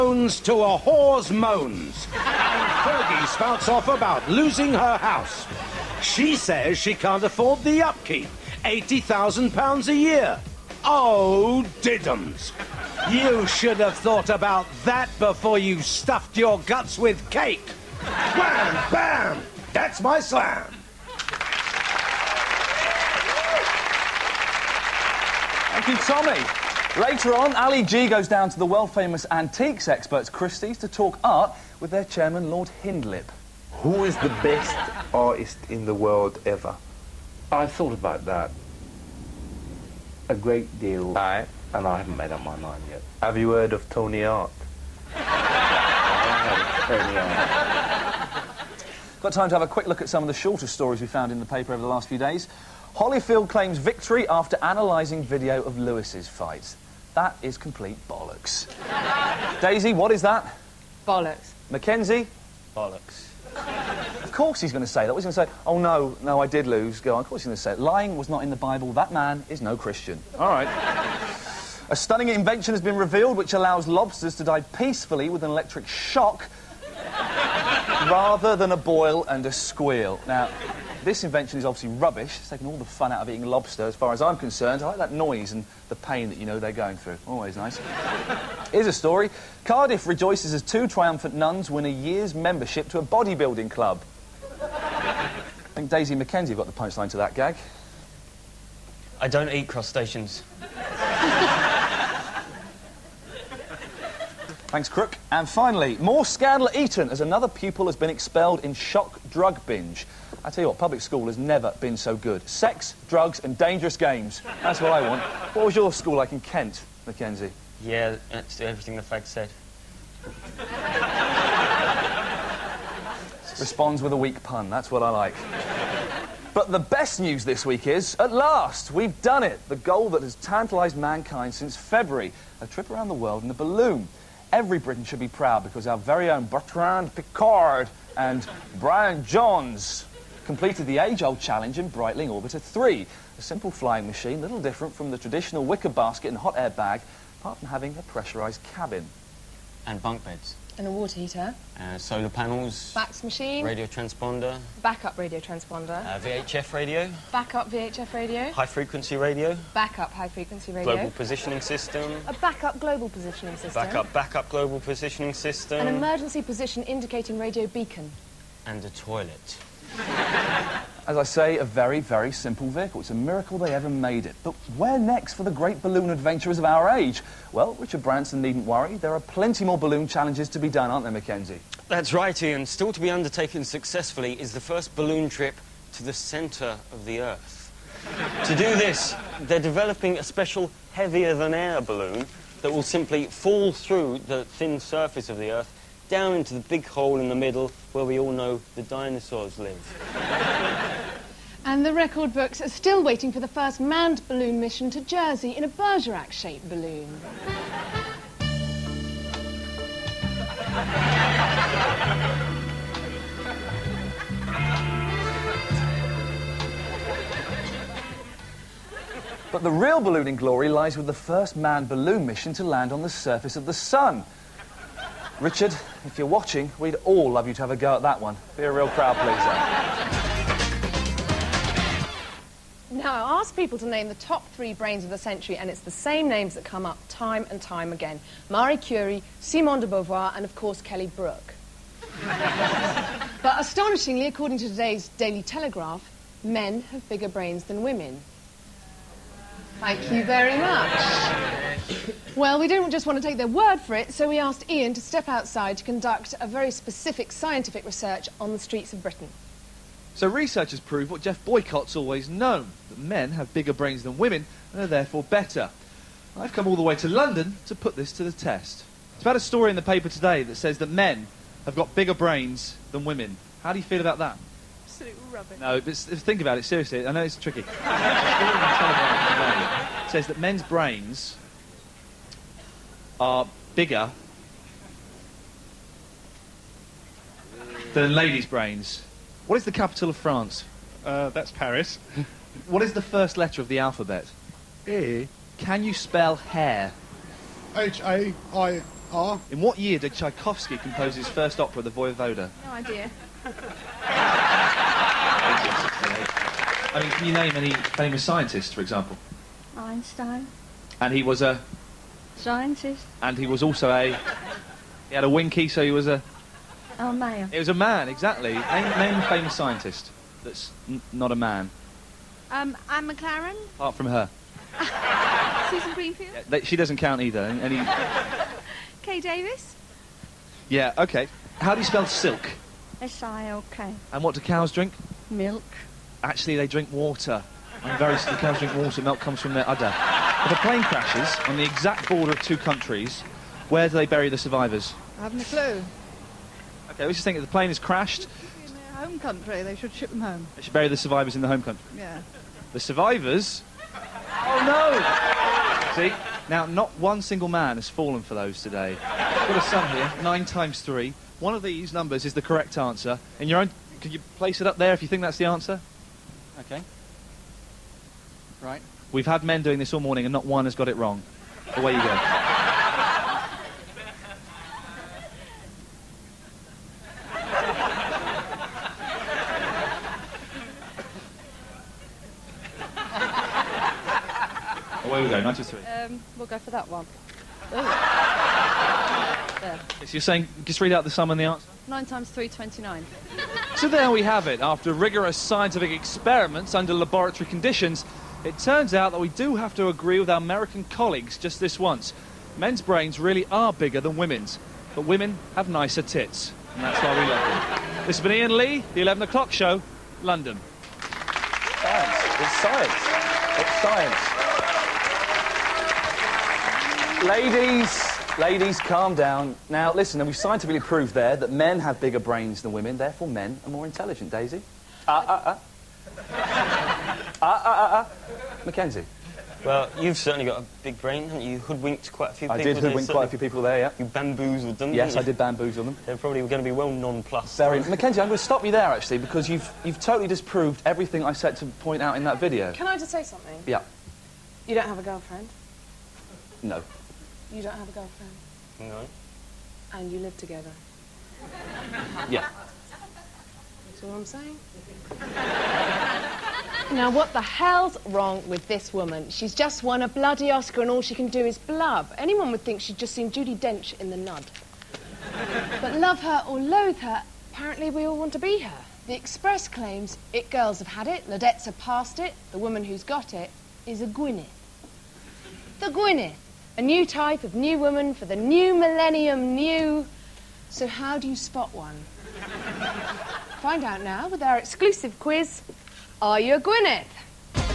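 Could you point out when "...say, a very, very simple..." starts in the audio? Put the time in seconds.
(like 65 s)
171 s.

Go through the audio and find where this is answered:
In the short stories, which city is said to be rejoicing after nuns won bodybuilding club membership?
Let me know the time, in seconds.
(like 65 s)
89 s.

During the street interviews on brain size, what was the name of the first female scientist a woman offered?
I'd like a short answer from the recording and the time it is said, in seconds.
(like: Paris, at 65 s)
Anne McLaren, at 322 s.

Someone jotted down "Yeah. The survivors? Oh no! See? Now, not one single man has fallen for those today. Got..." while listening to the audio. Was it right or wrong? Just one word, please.
right.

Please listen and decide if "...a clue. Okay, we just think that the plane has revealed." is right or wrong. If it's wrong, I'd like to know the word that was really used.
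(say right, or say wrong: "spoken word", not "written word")
wrong: "crashed", not "revealed".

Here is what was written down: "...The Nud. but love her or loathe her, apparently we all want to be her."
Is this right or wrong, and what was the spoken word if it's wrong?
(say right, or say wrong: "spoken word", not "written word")
right.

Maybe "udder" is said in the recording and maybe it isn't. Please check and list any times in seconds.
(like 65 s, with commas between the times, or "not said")
339 s.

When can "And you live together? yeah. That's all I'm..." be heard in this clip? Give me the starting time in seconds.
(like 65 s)
449 s.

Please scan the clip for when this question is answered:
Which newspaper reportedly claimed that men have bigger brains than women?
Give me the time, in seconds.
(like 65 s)
245 s.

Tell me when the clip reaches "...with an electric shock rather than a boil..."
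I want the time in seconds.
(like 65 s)
75 s.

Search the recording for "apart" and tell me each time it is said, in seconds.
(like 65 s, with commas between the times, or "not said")
147 s, 323 s.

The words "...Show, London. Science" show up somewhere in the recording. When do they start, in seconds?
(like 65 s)
409 s.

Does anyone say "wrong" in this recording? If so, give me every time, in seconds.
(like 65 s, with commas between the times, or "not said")
370 s, 458 s.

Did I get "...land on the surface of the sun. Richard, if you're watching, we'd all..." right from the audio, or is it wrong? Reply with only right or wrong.
right.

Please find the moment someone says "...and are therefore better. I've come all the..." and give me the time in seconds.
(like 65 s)
264 s.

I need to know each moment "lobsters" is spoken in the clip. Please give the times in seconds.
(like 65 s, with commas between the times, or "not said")
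73 s, 83 s.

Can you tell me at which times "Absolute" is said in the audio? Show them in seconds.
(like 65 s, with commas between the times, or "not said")
274 s.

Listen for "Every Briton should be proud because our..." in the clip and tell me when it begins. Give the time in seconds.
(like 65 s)
134 s.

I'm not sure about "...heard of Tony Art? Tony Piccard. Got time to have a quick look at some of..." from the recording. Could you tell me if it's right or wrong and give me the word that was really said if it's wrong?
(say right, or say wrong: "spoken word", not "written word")
wrong: "Art", not "Piccard".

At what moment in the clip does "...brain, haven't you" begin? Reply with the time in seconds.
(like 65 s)
431 s.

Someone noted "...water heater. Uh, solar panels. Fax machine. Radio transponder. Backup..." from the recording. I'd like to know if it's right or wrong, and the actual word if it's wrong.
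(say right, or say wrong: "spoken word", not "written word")
right.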